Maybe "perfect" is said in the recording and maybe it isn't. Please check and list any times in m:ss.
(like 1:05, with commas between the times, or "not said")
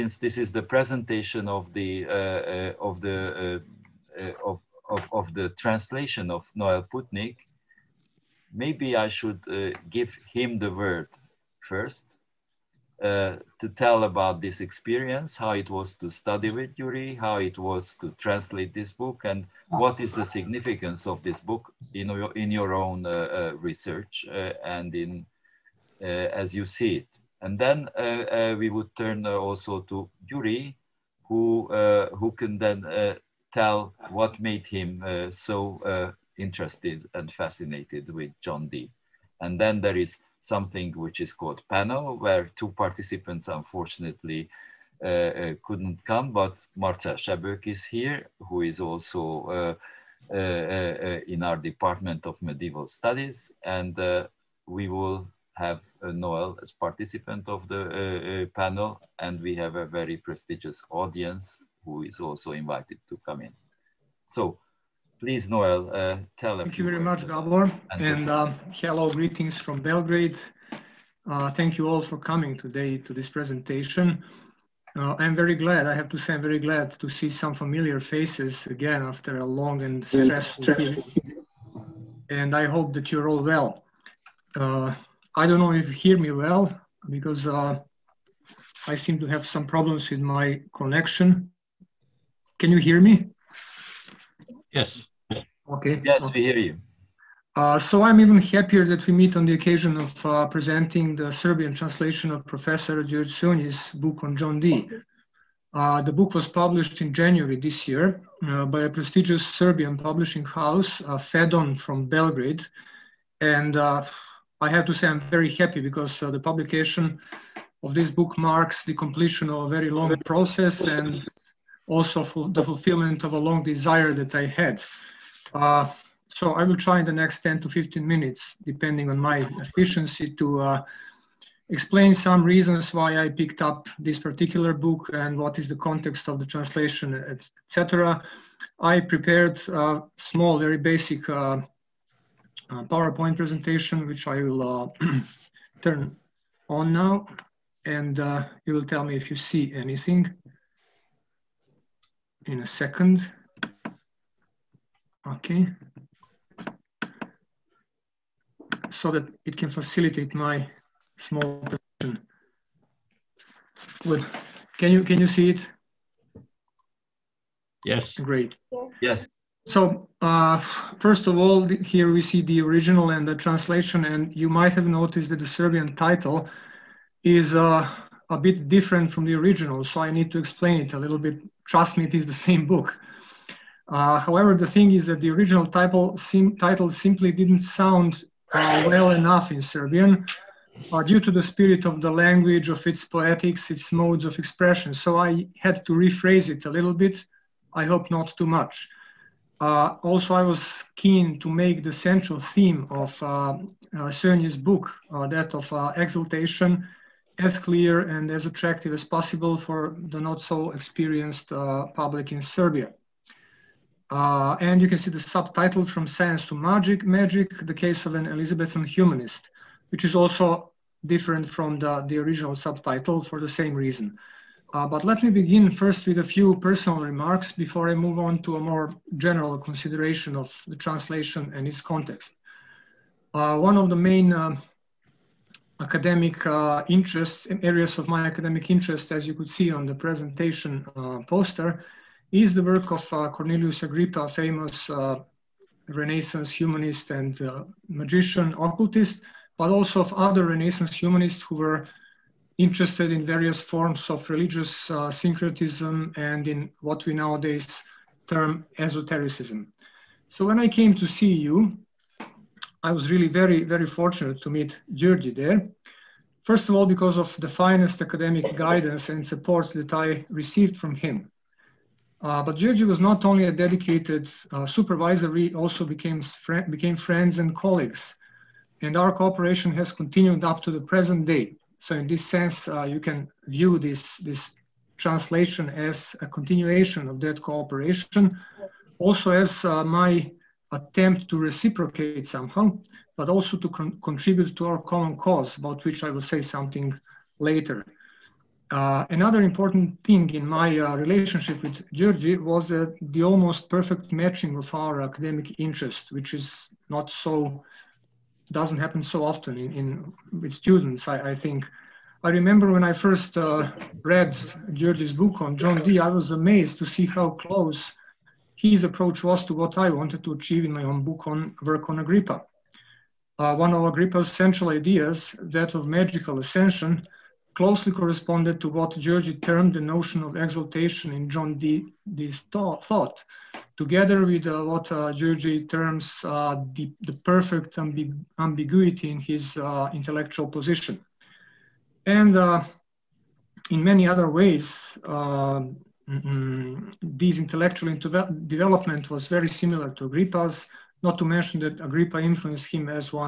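5:03, 5:37.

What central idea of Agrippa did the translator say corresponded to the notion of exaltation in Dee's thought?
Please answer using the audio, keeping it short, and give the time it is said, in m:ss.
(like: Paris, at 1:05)
magical ascension, at 5:25.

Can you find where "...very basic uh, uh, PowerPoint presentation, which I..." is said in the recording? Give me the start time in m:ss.
2:20.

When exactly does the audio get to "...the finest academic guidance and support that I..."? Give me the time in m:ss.
4:27.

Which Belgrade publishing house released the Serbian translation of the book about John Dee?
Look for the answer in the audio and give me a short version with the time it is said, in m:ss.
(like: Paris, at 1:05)
Fedon, at 1:51.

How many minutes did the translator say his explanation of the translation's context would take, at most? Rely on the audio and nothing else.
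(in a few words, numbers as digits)
15.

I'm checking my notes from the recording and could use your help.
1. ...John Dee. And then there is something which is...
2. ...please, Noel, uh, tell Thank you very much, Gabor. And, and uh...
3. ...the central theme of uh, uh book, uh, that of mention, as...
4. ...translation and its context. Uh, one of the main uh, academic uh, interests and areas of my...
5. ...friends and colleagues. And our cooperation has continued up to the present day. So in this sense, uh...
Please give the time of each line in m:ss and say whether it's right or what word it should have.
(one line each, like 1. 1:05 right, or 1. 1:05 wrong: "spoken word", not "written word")
1. 0:38 right
2. 1:05 right
3. 3:21 wrong: "exaltation", not "mention"
4. 3:50 right
5. 4:36 right.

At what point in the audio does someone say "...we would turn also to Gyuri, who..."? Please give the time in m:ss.
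0:28.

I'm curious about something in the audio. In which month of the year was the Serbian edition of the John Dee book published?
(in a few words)
January.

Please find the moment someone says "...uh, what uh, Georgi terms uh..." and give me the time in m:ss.
5:34.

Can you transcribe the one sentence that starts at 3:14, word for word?
So I had to rephrase it a little bit.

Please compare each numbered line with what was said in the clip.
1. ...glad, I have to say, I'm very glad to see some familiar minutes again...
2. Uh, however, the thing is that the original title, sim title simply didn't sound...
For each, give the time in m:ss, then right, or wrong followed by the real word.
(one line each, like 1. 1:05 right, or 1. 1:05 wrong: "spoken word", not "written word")
1. 1:15 wrong: "faces", not "minutes"
2. 3:03 right.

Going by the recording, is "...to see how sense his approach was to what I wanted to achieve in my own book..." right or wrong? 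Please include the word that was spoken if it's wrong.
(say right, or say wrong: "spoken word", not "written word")
wrong: "close", not "sense".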